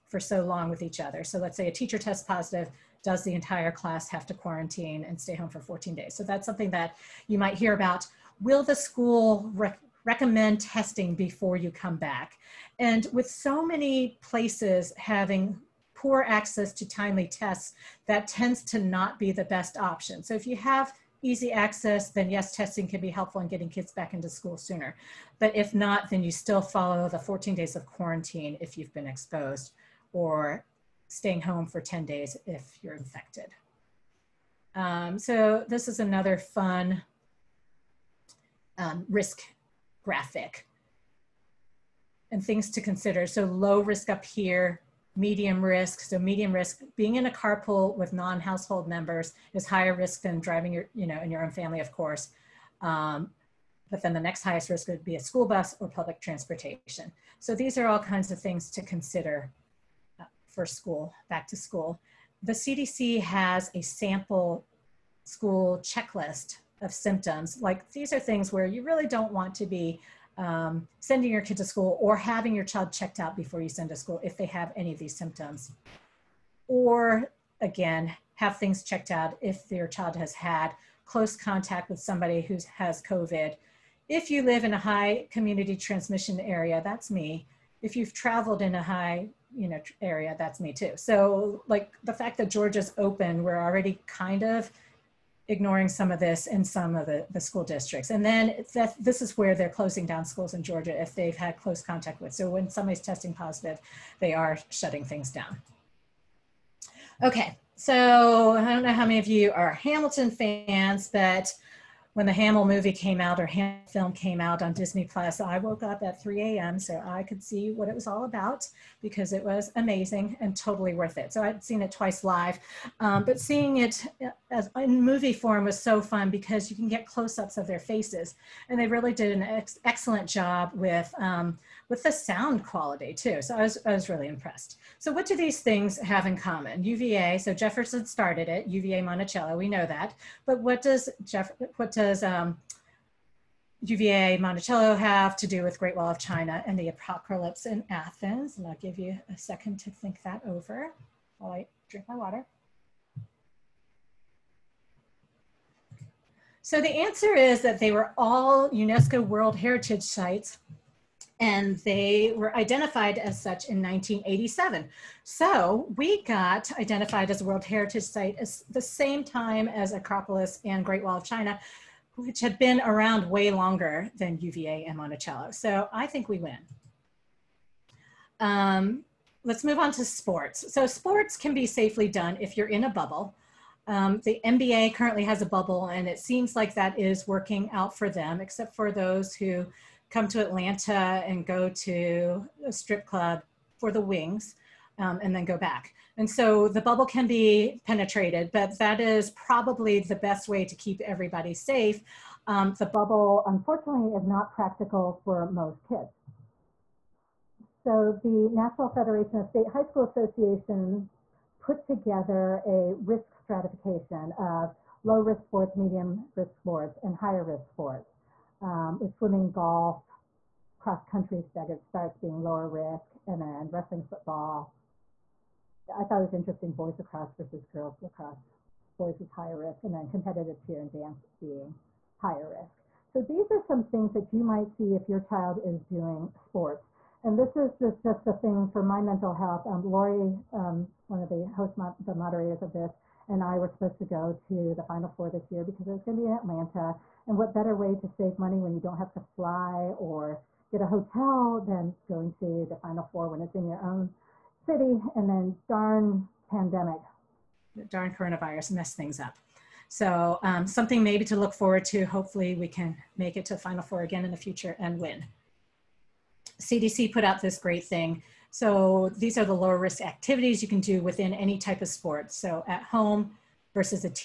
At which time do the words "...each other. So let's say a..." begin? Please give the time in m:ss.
0:00.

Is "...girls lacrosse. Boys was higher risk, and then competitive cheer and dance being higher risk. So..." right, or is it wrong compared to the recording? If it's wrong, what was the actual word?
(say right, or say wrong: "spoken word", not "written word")
right.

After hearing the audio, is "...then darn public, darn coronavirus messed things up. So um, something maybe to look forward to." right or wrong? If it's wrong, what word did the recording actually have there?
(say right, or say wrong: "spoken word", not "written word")
wrong: "pandemic", not "public".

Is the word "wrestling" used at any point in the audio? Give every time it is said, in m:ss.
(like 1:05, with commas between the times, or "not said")
3:43.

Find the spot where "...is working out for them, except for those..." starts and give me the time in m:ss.
3:06.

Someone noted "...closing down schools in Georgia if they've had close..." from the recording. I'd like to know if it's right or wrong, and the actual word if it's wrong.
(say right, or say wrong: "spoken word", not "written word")
right.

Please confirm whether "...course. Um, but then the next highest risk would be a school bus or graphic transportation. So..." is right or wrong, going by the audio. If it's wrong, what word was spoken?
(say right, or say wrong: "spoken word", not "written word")
wrong: "public", not "graphic".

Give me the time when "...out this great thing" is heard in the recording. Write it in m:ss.
4:27.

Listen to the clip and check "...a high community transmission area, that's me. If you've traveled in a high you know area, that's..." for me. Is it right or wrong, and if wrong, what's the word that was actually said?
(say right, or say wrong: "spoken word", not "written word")
right.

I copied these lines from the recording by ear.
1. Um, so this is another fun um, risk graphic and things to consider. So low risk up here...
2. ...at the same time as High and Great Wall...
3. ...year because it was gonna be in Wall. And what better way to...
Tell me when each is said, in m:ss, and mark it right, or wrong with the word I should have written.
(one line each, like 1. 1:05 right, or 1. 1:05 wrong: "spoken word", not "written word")
1. 0:34 right
2. 2:48 wrong: "Acropolis", not "High"
3. 4:05 wrong: "Atlanta", not "Wall".